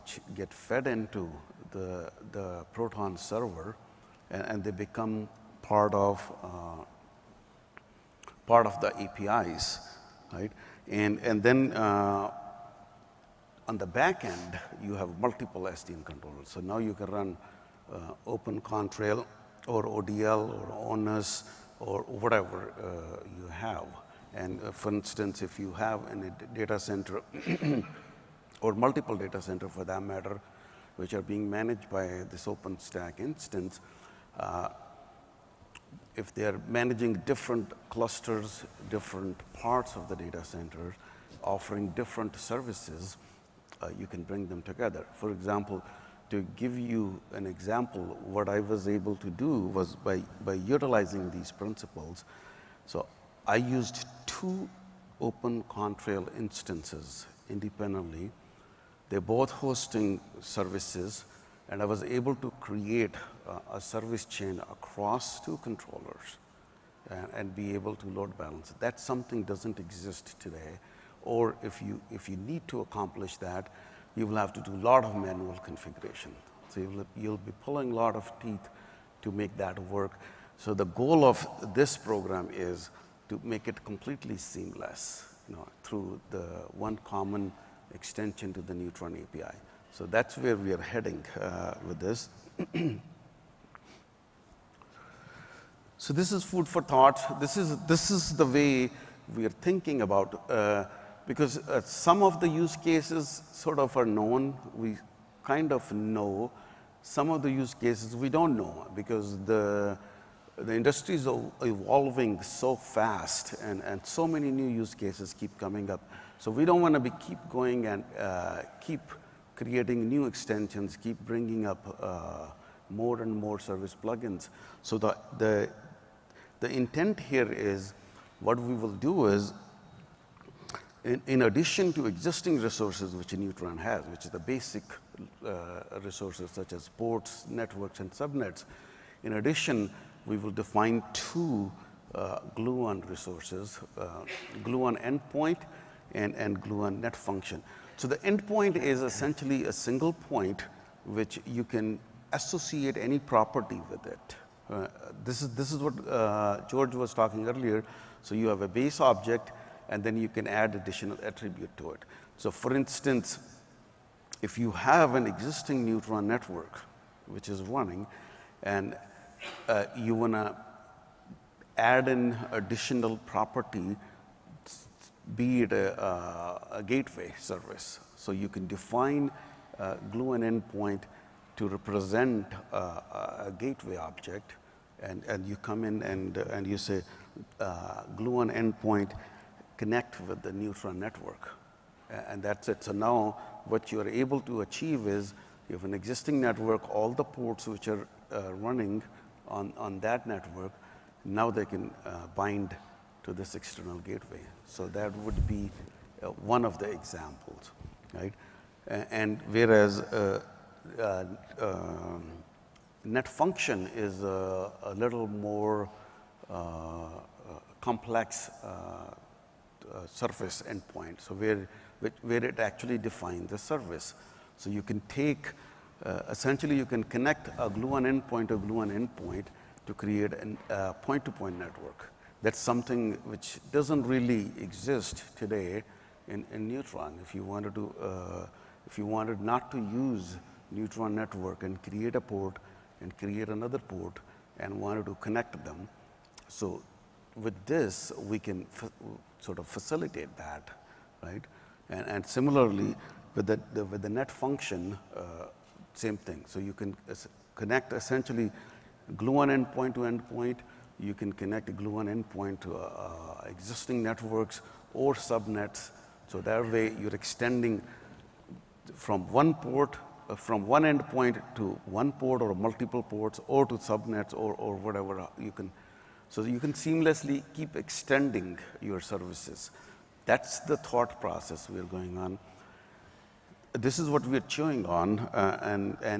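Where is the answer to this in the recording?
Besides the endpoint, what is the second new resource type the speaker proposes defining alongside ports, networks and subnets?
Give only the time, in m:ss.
2:26.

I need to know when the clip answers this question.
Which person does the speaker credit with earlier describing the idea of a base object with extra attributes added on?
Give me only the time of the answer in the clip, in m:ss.
2:36.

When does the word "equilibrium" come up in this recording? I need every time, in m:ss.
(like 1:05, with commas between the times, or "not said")
not said.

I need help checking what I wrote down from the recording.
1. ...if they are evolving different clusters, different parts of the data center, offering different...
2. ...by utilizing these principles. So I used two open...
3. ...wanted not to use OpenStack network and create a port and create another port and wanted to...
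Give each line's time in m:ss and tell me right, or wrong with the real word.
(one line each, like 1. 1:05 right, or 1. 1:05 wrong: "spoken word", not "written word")
1. 0:36 wrong: "managing", not "evolving"
2. 0:50 right
3. 3:59 wrong: "Neutron", not "OpenStack".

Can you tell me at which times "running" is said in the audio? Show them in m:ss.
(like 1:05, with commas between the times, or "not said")
2:47, 3:18.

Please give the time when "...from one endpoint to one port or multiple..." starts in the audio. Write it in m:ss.
4:30.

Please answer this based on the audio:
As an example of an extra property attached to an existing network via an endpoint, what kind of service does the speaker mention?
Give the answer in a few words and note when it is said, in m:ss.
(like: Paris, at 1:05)
gateway service, at 2:56.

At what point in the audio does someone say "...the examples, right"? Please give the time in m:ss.
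3:26.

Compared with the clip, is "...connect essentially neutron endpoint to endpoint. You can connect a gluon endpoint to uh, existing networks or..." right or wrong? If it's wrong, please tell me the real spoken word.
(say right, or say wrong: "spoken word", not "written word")
wrong: "gluon", not "neutron".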